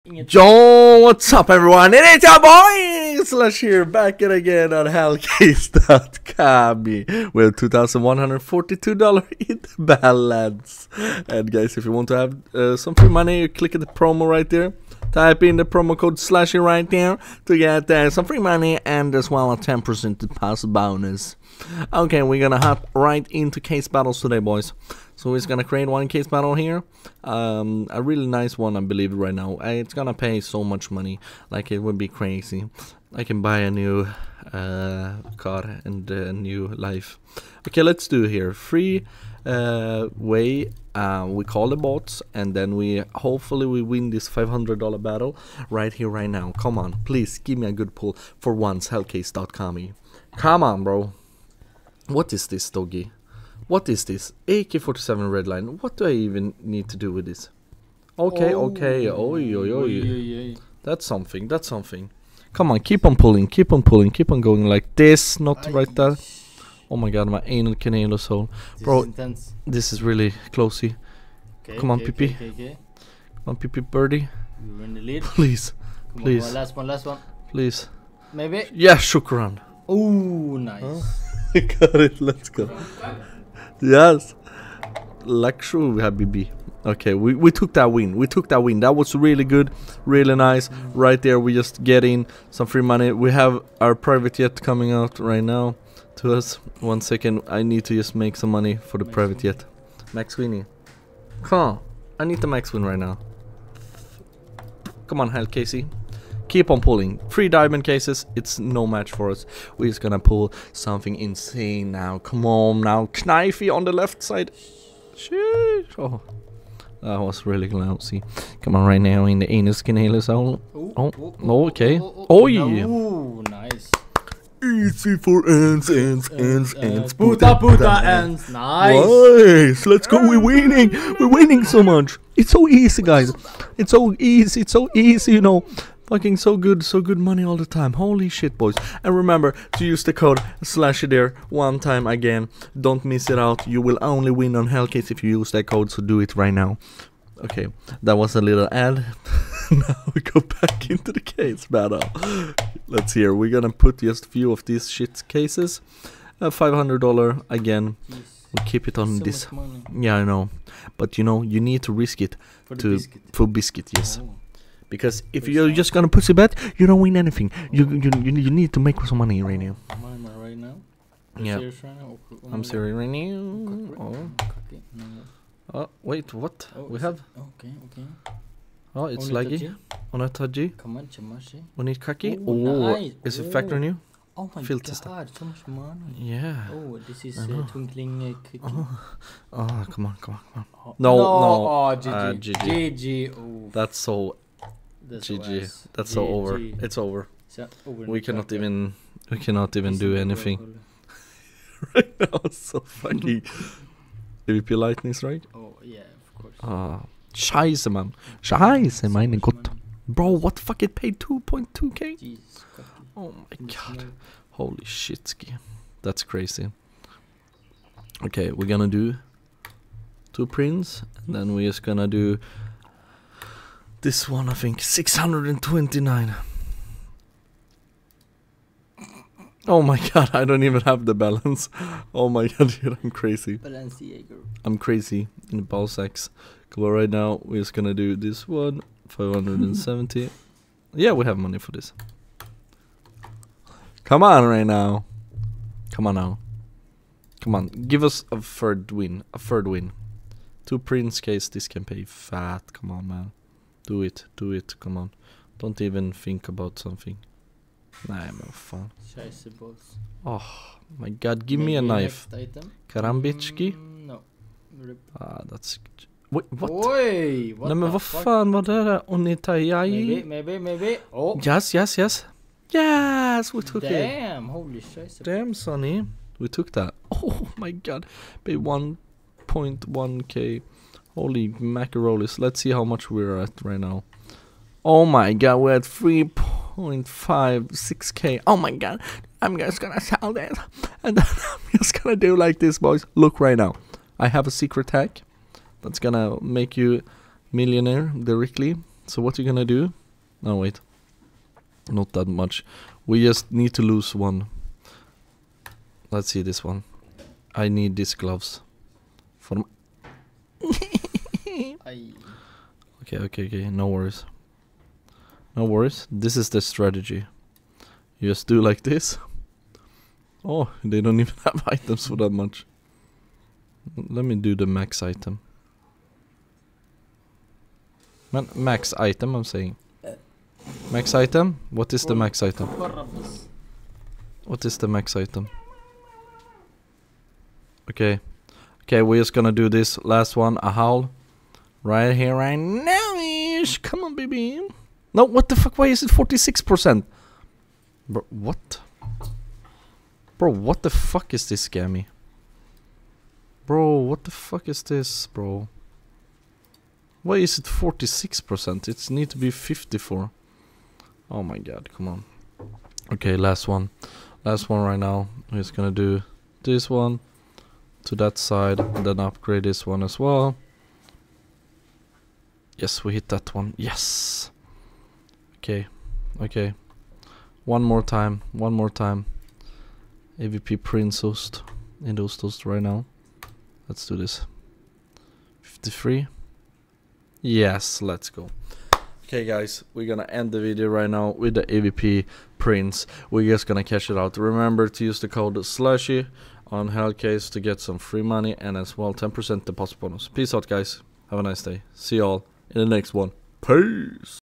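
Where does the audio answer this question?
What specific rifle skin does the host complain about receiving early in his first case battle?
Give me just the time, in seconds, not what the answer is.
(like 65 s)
54 s.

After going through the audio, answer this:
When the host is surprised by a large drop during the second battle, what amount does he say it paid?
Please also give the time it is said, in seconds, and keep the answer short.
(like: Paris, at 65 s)
2.2k, at 211 s.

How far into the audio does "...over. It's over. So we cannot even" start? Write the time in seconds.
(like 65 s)
196 s.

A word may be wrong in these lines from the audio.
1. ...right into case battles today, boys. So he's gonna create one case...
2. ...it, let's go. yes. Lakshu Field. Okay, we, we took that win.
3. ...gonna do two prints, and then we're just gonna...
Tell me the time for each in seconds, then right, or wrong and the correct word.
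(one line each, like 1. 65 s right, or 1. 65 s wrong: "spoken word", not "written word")
1. 22 s right
2. 82 s wrong: "Habibi", not "Field"
3. 218 s right.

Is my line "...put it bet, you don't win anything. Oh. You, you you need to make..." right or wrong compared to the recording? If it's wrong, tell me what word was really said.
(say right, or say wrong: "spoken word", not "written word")
right.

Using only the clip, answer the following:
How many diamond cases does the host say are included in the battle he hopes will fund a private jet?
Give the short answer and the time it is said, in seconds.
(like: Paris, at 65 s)
3, at 107 s.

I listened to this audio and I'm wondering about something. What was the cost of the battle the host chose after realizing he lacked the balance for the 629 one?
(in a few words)
570.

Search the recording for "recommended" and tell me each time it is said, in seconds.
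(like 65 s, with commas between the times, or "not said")
not said.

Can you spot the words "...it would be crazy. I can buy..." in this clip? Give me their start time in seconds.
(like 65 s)
31 s.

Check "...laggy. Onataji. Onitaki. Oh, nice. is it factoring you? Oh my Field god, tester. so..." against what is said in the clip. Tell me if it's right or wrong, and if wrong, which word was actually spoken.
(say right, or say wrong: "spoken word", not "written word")
right.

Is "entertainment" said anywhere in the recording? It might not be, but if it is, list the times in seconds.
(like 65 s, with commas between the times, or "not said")
not said.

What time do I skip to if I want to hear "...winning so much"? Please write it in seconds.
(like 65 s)
131 s.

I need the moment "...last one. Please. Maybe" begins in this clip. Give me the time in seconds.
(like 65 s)
76 s.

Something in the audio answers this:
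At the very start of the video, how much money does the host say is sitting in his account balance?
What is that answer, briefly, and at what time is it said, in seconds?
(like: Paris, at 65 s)
$2,142, at 7 s.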